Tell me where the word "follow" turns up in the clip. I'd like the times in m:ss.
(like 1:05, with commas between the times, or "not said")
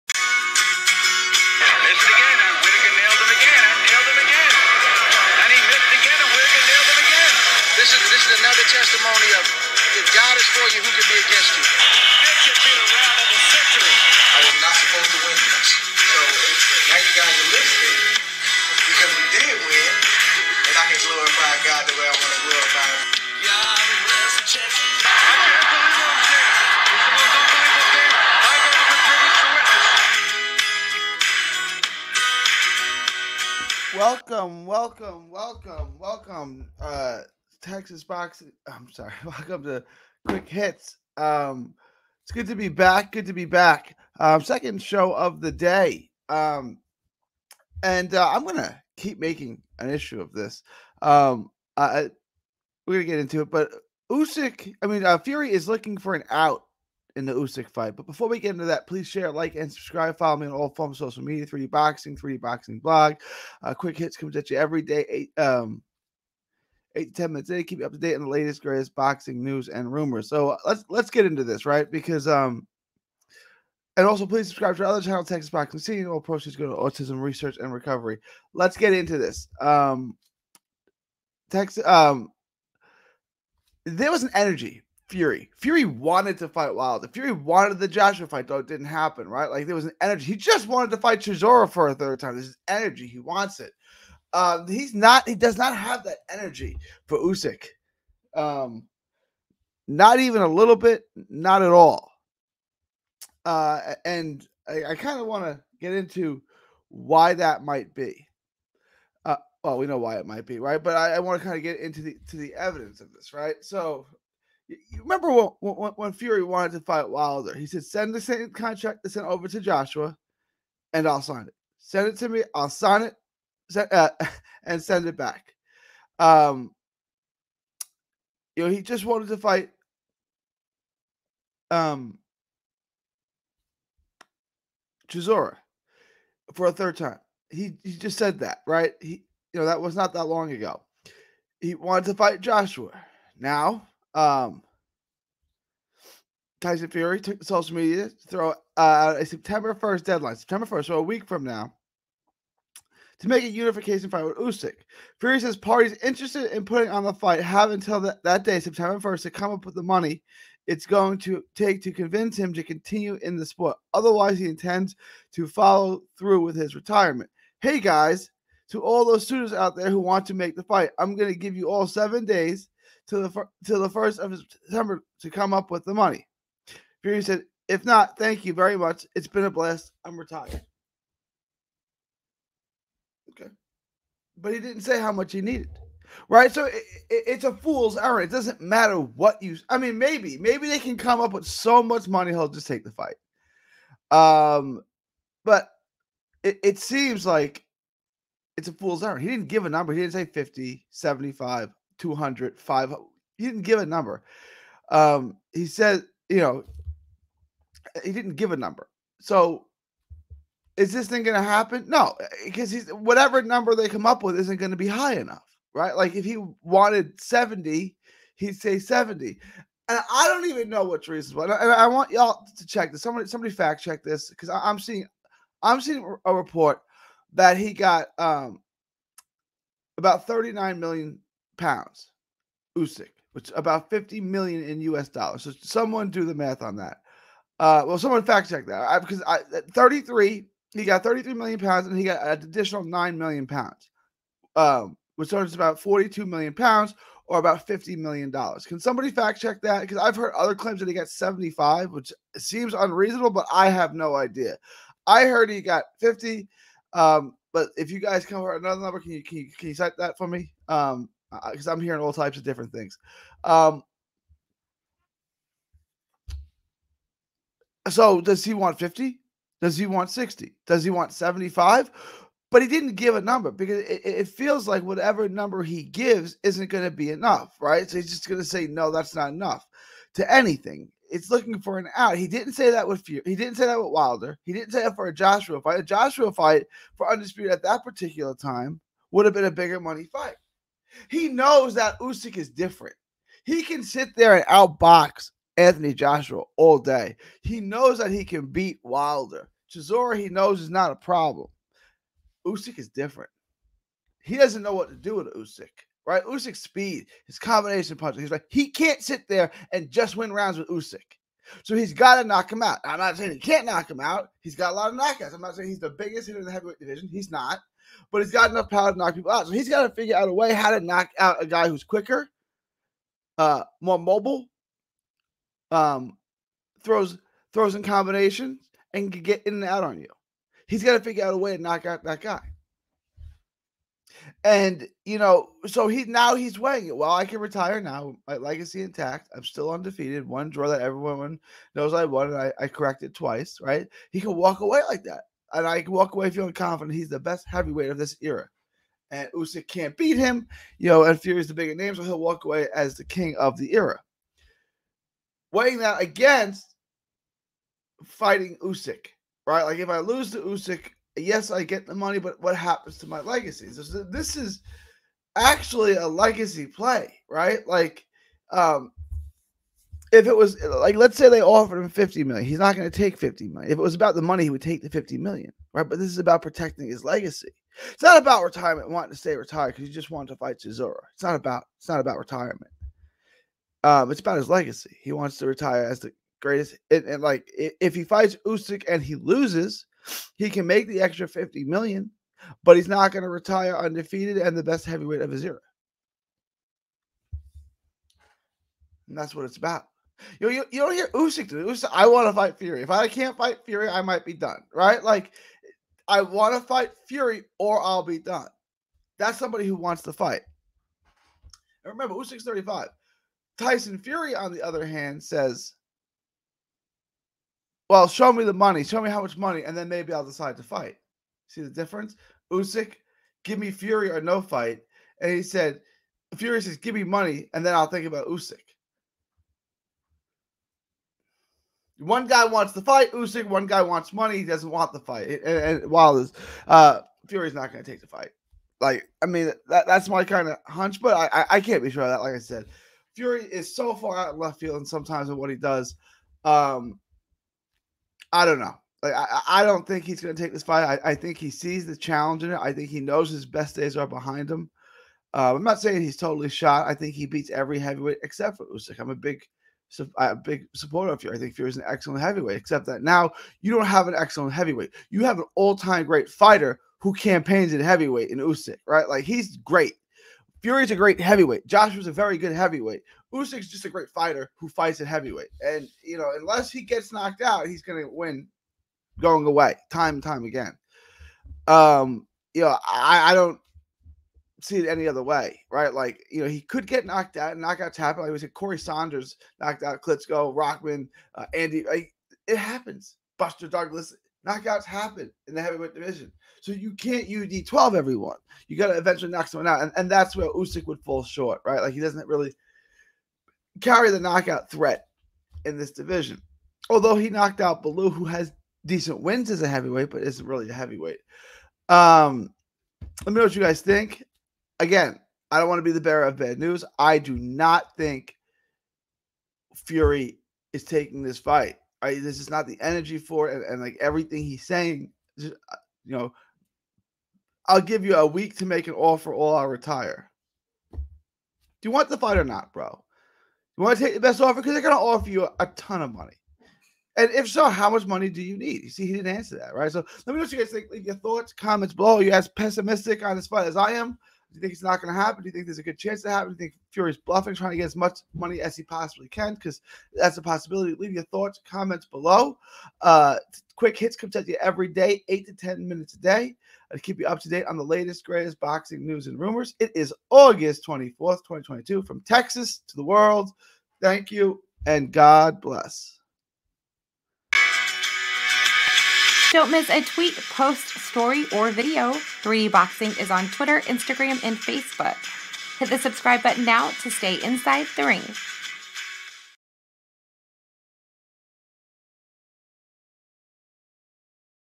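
1:00, 2:45.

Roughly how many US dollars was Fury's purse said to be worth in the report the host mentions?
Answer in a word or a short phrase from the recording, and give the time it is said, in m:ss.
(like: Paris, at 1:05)
50 million, at 3:53.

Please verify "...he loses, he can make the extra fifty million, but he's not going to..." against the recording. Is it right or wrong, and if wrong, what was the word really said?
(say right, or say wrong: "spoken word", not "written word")
right.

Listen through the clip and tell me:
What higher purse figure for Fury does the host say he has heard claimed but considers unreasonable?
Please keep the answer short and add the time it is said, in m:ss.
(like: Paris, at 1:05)
75, at 4:10.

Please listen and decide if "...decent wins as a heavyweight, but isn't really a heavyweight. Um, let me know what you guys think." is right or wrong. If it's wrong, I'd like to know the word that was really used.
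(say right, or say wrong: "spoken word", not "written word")
right.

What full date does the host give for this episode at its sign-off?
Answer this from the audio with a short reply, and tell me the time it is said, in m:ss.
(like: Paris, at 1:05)
August 24th, 2022, at 9:20.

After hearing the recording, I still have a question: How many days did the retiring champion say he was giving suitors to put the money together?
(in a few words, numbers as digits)
7.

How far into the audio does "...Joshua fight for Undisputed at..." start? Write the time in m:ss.
4:45.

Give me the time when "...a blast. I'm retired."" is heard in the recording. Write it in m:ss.
2:59.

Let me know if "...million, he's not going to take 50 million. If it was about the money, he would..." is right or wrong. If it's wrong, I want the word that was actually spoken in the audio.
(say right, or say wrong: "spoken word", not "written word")
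right.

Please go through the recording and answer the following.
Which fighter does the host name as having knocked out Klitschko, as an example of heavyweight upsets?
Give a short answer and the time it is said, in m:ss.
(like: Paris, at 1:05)
Corrie Sanders, at 8:08.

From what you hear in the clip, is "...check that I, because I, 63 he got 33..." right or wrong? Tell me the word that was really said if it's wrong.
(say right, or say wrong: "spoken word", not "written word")
wrong: "33", not "63".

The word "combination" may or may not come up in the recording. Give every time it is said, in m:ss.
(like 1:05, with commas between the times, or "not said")
5:07, 5:27.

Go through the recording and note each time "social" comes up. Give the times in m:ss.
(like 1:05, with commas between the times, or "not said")
1:01, 2:27.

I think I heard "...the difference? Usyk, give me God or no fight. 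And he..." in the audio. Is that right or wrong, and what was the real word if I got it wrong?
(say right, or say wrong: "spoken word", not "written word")
wrong: "Fury", not "God".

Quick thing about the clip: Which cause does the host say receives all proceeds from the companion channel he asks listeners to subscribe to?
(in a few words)
Autism Research and Recovery.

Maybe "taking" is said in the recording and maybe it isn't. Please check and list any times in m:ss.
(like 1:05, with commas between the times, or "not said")
8:40.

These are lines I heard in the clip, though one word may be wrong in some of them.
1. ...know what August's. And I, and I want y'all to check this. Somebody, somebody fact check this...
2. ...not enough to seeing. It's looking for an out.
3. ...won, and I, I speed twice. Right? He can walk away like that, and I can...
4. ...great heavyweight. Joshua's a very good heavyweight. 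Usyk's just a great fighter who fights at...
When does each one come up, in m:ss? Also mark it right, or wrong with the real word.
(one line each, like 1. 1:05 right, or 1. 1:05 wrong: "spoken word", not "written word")
1. 3:40 wrong: "Teresa", not "August"
2. 4:39 wrong: "anything", not "seeing"
3. 5:42 wrong: "corrected", not "speed"
4. 7:50 right.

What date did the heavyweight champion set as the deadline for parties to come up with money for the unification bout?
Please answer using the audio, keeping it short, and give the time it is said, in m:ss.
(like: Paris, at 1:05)
September 1st, at 2:30.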